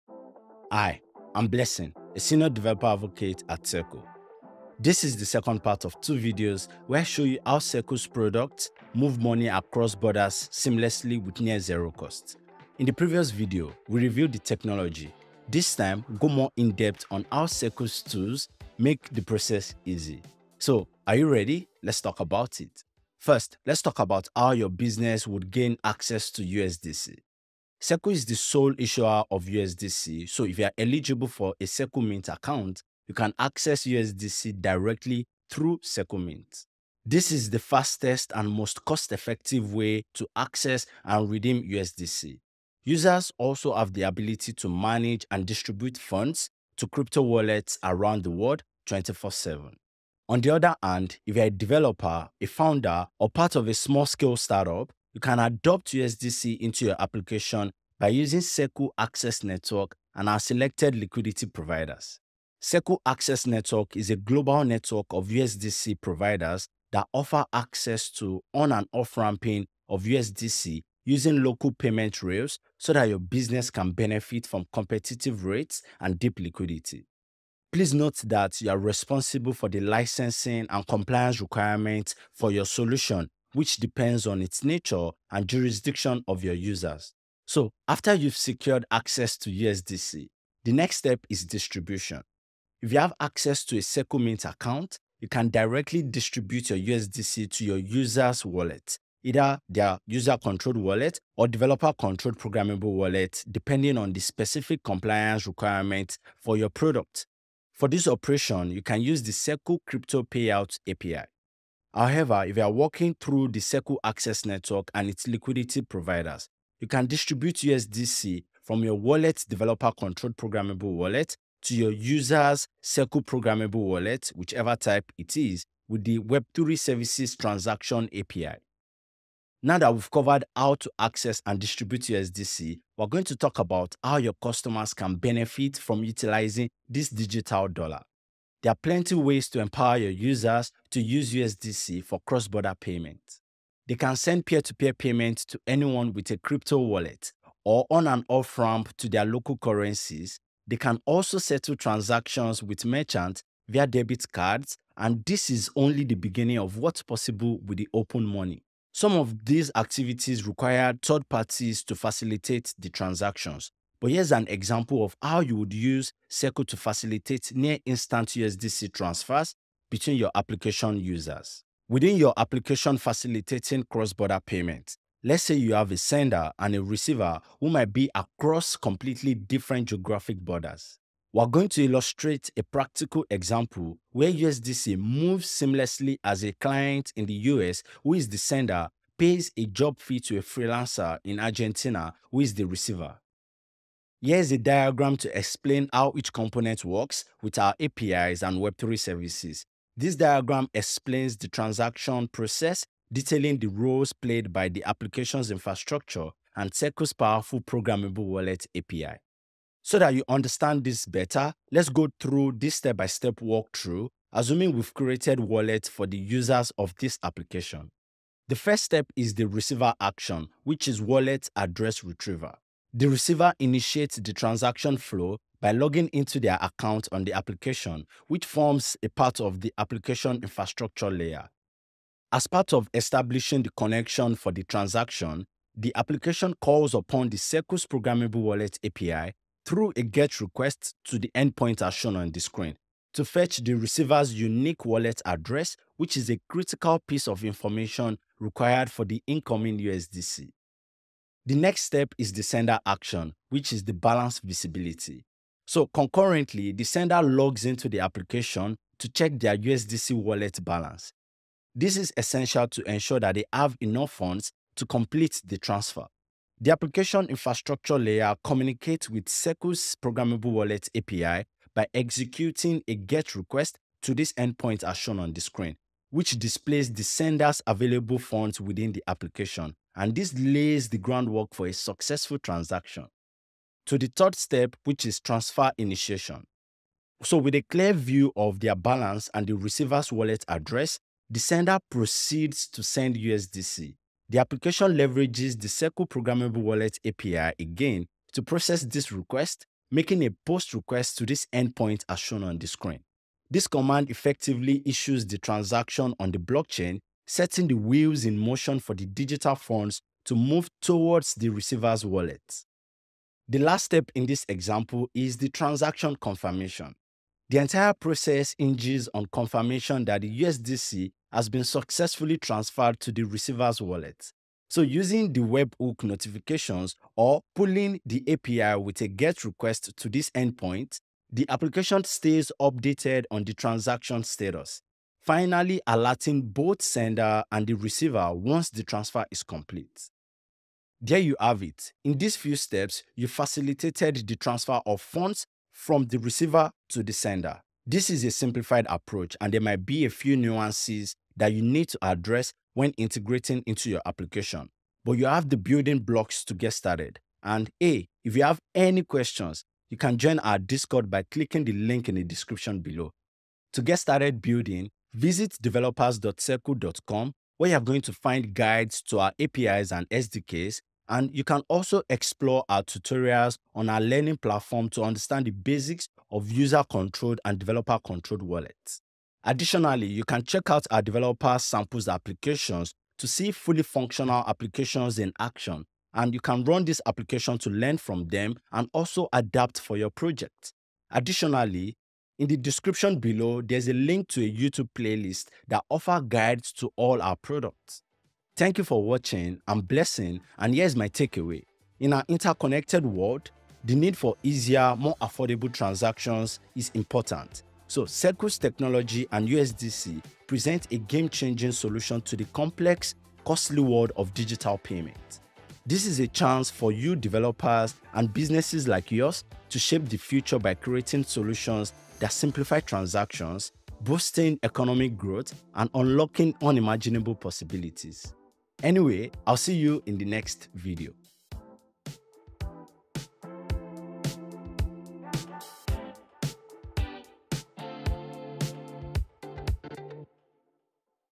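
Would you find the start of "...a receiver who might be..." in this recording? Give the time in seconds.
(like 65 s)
176 s.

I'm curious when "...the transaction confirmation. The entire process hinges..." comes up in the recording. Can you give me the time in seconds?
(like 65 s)
315 s.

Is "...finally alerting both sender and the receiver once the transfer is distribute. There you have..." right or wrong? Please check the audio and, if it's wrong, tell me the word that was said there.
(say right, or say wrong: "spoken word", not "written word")
wrong: "complete", not "distribute".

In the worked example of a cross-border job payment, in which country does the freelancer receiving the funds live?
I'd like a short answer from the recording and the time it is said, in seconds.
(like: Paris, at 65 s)
Argentina, at 191 s.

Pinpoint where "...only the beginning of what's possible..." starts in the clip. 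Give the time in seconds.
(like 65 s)
155 s.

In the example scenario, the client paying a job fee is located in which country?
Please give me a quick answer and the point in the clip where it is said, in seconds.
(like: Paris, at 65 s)
US, at 187 s.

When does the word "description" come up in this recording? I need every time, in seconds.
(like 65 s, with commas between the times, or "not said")
362 s, 392 s.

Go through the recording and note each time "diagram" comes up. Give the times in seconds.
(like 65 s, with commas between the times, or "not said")
194 s, 200 s.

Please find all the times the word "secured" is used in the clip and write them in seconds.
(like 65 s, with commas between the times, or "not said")
88 s.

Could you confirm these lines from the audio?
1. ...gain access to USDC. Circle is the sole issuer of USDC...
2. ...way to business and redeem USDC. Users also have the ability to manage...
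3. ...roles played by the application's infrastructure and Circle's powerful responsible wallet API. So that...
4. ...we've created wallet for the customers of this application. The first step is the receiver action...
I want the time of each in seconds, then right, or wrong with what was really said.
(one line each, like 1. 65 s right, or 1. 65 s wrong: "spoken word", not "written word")
1. 25 s right
2. 39 s wrong: "access", not "business"
3. 203 s wrong: "programmable", not "responsible"
4. 214 s wrong: "users", not "customers".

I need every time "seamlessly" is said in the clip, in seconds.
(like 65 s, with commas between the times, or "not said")
10 s, 185 s.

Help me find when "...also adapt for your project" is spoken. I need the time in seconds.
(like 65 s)
388 s.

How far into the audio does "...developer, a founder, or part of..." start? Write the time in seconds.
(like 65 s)
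51 s.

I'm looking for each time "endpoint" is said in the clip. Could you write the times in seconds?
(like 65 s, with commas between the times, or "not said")
241 s, 274 s, 301 s, 330 s.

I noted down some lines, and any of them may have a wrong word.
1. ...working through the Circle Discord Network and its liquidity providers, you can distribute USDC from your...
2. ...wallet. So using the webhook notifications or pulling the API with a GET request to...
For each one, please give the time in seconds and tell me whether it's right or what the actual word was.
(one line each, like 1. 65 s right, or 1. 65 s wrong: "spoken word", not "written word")
1. 112 s wrong: "Access", not "Discord"
2. 323 s right.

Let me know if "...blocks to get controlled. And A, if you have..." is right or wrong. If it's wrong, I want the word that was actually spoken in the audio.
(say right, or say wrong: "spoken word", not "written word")
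wrong: "started", not "controlled".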